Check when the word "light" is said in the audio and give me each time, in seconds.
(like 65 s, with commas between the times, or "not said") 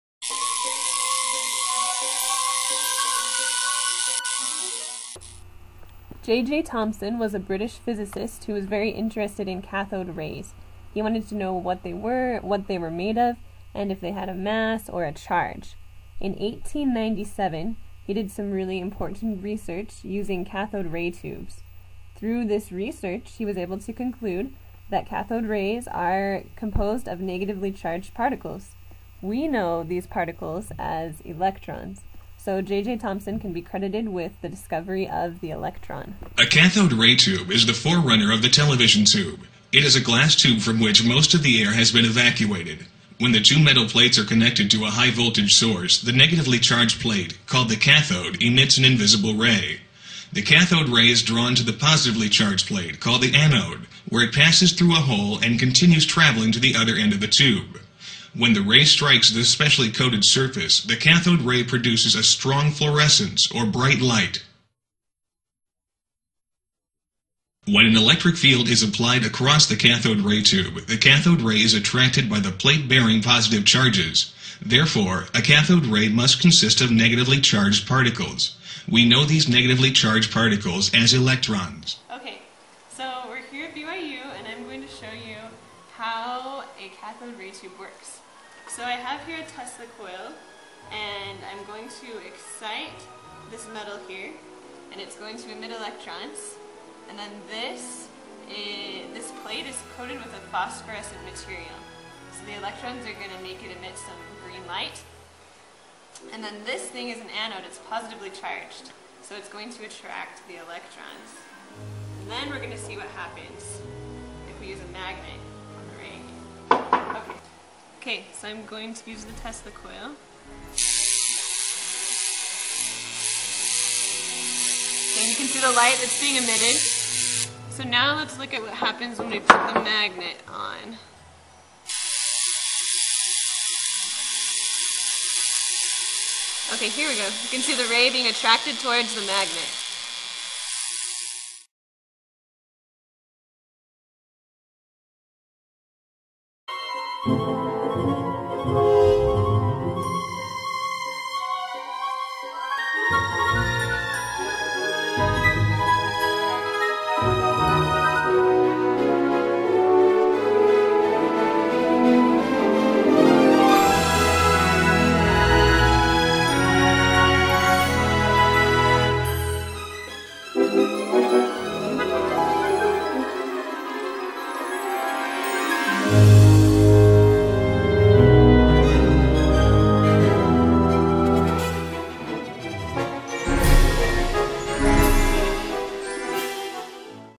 63 s, 104 s, 125 s.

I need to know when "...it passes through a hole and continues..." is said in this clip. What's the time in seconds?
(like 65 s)
54 s.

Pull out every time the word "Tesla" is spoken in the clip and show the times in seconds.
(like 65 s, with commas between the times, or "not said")
89 s, 119 s.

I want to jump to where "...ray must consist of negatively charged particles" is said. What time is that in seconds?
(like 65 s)
75 s.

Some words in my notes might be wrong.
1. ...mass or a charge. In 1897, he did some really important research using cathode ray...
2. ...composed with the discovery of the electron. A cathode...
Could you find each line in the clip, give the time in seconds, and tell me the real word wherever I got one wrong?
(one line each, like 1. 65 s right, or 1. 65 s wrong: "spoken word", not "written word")
1. 14 s right
2. 33 s wrong: "credited", not "composed".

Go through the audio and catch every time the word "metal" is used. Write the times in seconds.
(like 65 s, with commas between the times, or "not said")
43 s, 93 s.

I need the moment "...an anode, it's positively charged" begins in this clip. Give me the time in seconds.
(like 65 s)
107 s.